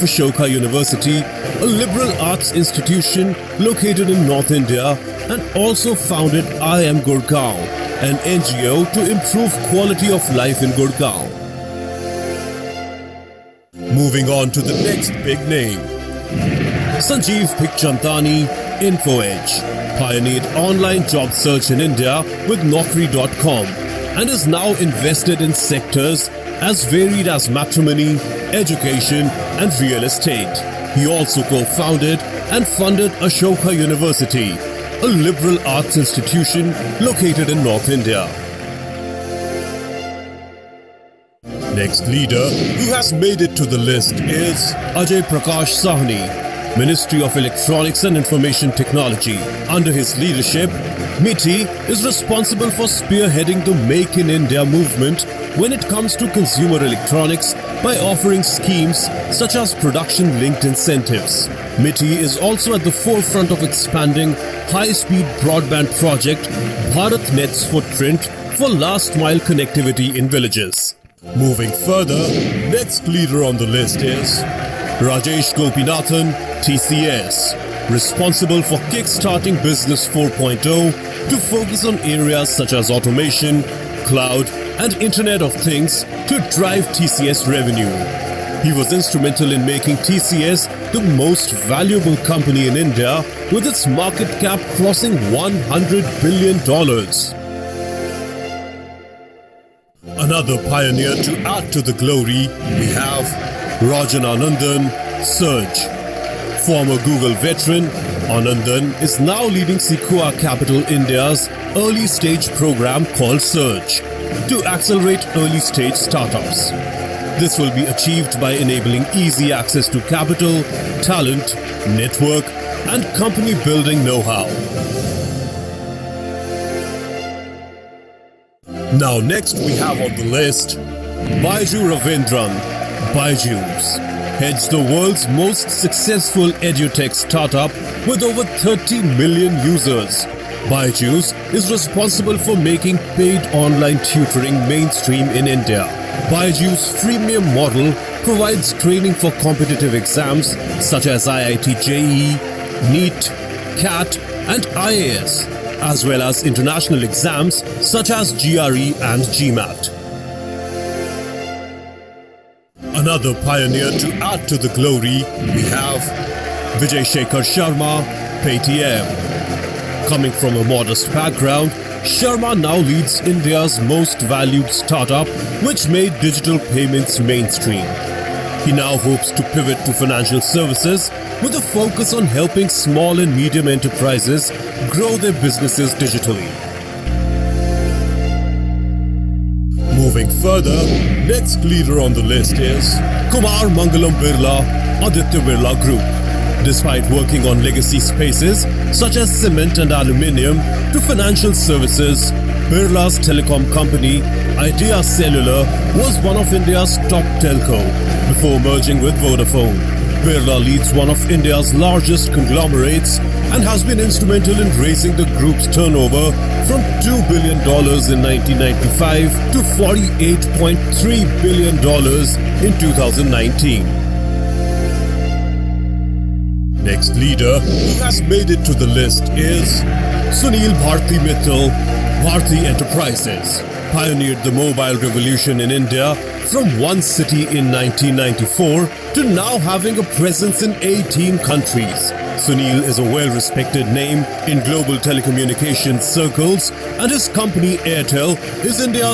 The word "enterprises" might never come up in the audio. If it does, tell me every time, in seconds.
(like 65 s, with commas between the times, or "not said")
183 s, 232 s.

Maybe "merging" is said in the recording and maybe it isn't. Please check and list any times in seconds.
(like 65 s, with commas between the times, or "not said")
208 s.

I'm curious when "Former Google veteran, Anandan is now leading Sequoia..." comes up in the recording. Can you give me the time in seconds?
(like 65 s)
106 s.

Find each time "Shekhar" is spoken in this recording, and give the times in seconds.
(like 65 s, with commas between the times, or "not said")
167 s.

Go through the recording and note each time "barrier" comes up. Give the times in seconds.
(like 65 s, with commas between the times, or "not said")
not said.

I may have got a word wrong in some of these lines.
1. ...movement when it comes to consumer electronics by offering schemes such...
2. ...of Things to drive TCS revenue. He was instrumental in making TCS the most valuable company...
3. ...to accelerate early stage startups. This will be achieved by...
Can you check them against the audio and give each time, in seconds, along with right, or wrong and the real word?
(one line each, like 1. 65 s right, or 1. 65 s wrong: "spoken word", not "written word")
1. 54 s right
2. 85 s right
3. 114 s right.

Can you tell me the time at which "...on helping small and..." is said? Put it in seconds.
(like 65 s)
182 s.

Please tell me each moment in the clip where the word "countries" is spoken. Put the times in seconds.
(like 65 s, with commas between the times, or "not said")
241 s.